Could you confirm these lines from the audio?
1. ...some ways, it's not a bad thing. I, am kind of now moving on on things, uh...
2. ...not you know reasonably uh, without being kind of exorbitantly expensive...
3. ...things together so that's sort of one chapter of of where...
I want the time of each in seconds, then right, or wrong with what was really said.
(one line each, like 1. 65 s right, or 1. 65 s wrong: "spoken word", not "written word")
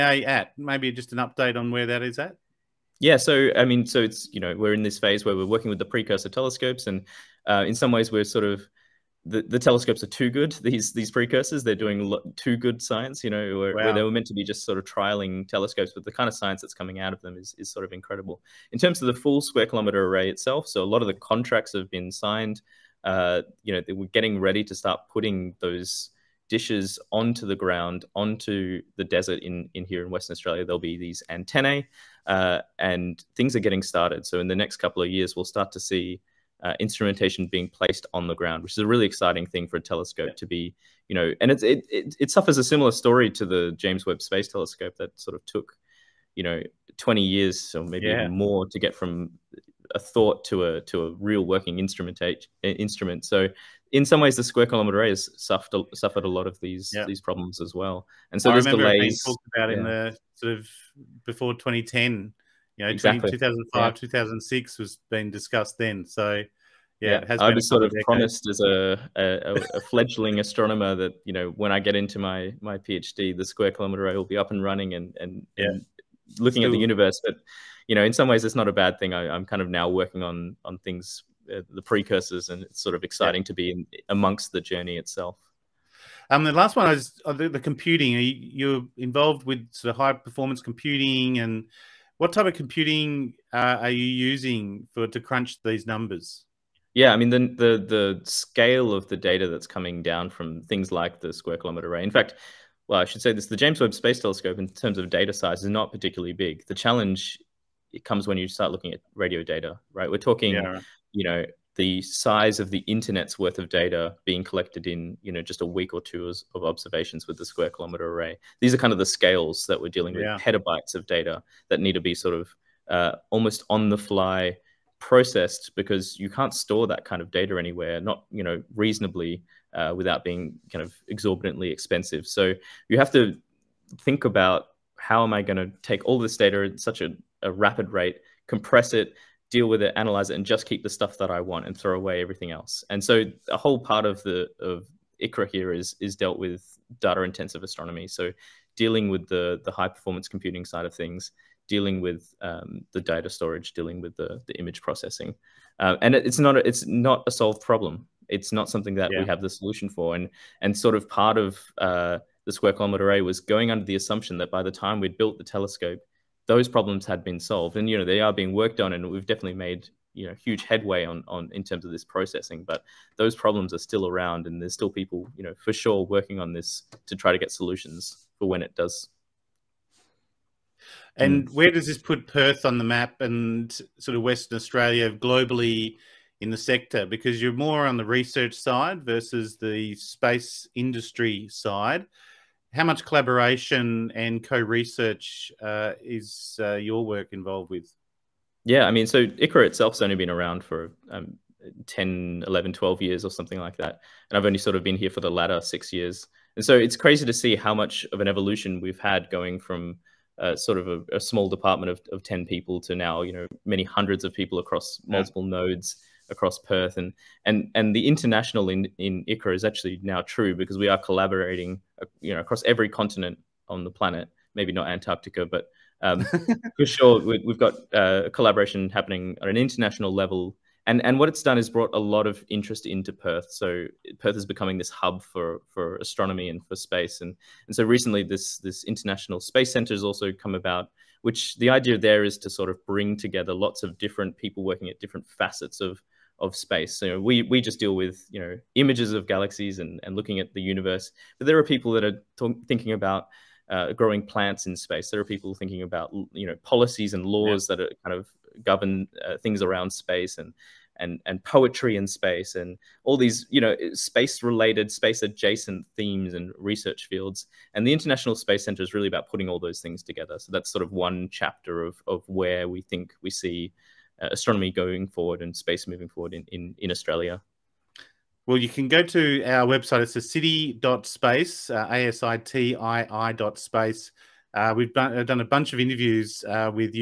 1. 78 s wrong: "working", not "moving"
2. 127 s right
3. 269 s right.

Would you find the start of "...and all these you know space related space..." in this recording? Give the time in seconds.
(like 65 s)
262 s.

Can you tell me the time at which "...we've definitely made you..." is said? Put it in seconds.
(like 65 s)
169 s.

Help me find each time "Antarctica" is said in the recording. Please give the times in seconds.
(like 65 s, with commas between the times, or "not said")
224 s.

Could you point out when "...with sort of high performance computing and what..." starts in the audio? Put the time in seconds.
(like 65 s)
89 s.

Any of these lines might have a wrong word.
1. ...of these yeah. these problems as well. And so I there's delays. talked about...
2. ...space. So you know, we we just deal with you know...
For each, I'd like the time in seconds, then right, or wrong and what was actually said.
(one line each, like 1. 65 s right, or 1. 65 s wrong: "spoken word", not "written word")
1. 56 s right
2. 246 s right.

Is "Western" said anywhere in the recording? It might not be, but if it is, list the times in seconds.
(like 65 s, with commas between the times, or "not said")
30 s, 184 s.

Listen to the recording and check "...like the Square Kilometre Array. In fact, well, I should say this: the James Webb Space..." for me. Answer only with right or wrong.
right.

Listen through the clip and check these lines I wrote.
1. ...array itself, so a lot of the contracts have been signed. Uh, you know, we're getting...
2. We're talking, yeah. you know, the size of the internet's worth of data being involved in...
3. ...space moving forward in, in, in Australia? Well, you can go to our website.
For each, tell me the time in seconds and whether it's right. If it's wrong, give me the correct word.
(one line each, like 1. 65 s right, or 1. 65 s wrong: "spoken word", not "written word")
1. 20 s right
2. 110 s wrong: "collected", not "involved"
3. 275 s right.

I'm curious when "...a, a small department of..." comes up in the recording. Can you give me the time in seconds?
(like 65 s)
210 s.